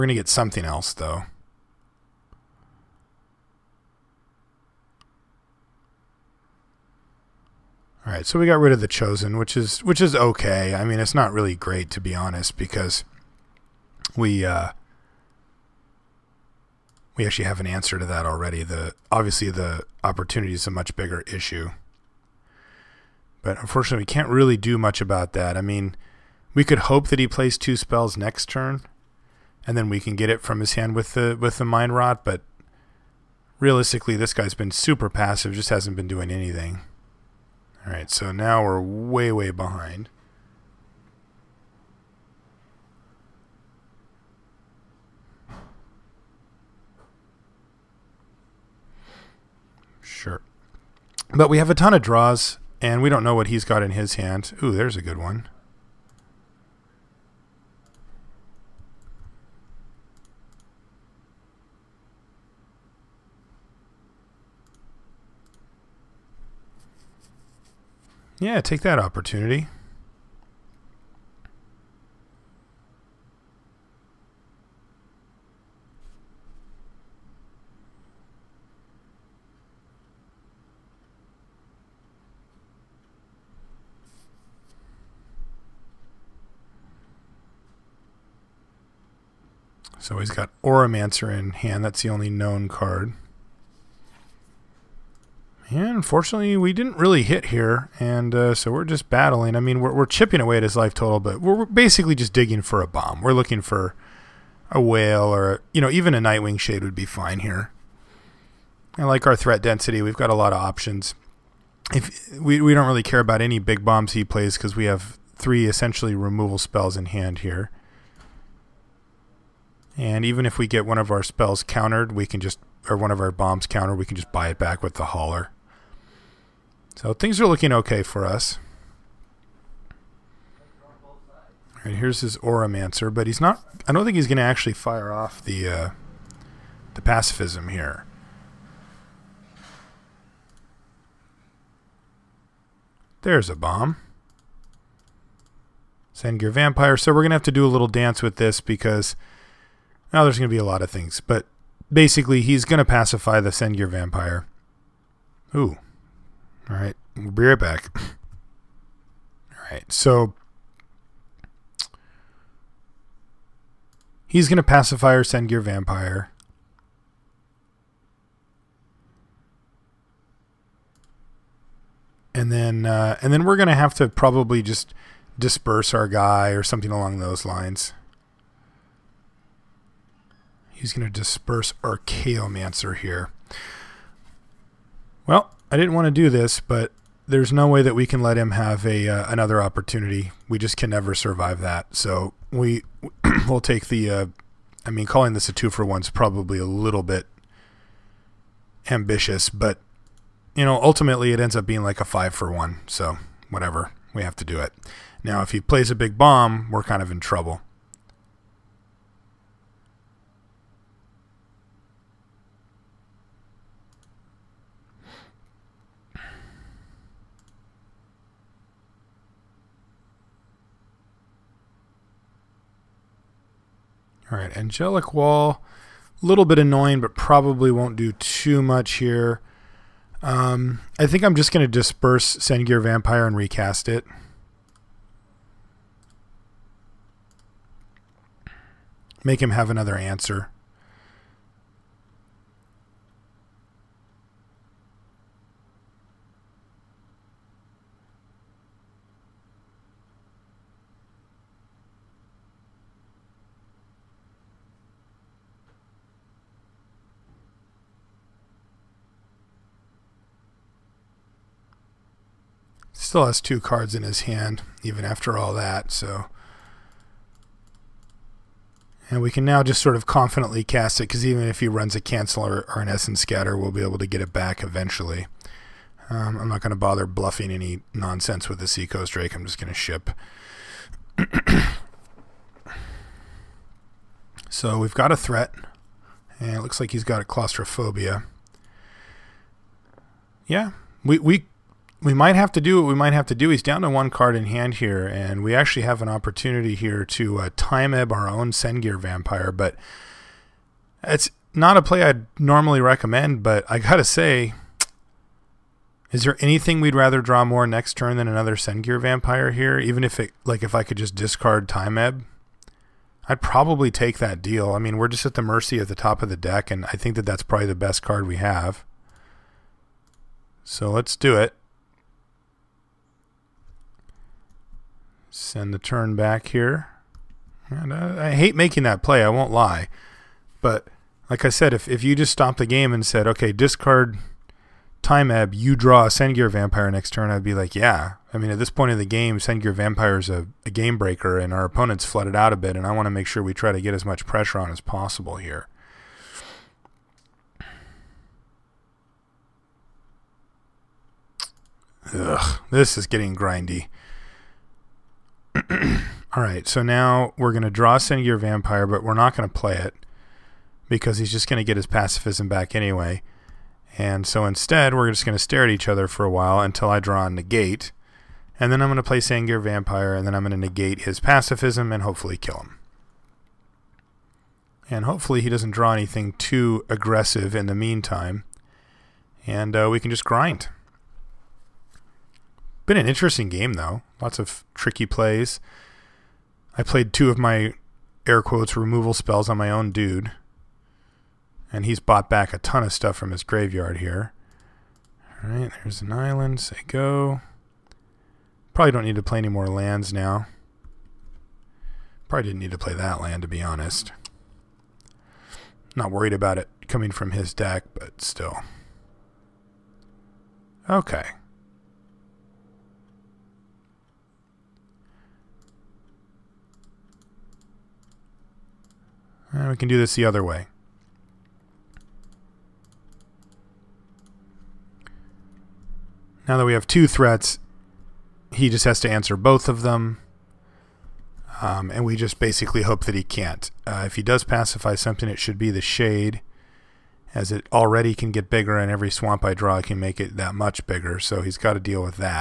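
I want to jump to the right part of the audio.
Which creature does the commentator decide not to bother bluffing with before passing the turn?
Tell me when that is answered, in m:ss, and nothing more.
4:38.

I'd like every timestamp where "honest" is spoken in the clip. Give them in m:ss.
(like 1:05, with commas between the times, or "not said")
0:12, 6:43.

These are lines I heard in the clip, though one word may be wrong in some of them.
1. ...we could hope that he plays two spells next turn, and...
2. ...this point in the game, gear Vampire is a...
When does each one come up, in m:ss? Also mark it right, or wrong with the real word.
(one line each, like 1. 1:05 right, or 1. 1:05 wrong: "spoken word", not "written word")
1. 0:26 right
2. 5:38 right.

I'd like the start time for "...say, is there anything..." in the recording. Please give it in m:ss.
5:04.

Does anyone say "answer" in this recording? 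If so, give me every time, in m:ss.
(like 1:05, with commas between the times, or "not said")
0:17, 3:59, 7:09.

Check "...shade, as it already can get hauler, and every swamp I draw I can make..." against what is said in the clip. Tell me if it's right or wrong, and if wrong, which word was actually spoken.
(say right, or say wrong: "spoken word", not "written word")
wrong: "bigger", not "hauler".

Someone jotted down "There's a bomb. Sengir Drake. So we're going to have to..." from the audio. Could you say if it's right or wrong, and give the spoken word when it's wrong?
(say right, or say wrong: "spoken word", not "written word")
wrong: "Vampire", not "Drake".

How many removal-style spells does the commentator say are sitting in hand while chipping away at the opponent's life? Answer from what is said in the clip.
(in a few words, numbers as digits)
3.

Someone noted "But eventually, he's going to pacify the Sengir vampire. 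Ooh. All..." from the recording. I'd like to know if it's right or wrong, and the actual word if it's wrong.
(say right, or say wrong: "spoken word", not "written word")
wrong: "basically", not "eventually".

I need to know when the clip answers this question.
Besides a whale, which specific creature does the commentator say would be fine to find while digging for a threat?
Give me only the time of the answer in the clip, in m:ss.
1:46.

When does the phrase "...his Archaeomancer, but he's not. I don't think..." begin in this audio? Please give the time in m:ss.
2:12.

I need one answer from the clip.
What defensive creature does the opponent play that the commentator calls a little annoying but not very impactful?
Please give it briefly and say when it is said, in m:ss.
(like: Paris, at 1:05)
Angelic Wall, at 3:44.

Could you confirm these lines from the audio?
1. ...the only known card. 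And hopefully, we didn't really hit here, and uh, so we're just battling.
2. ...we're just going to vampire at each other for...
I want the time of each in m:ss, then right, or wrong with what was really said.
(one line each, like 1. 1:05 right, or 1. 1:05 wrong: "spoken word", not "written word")
1. 1:32 wrong: "unfortunately", not "hopefully"
2. 6:04 wrong: "stare", not "vampire".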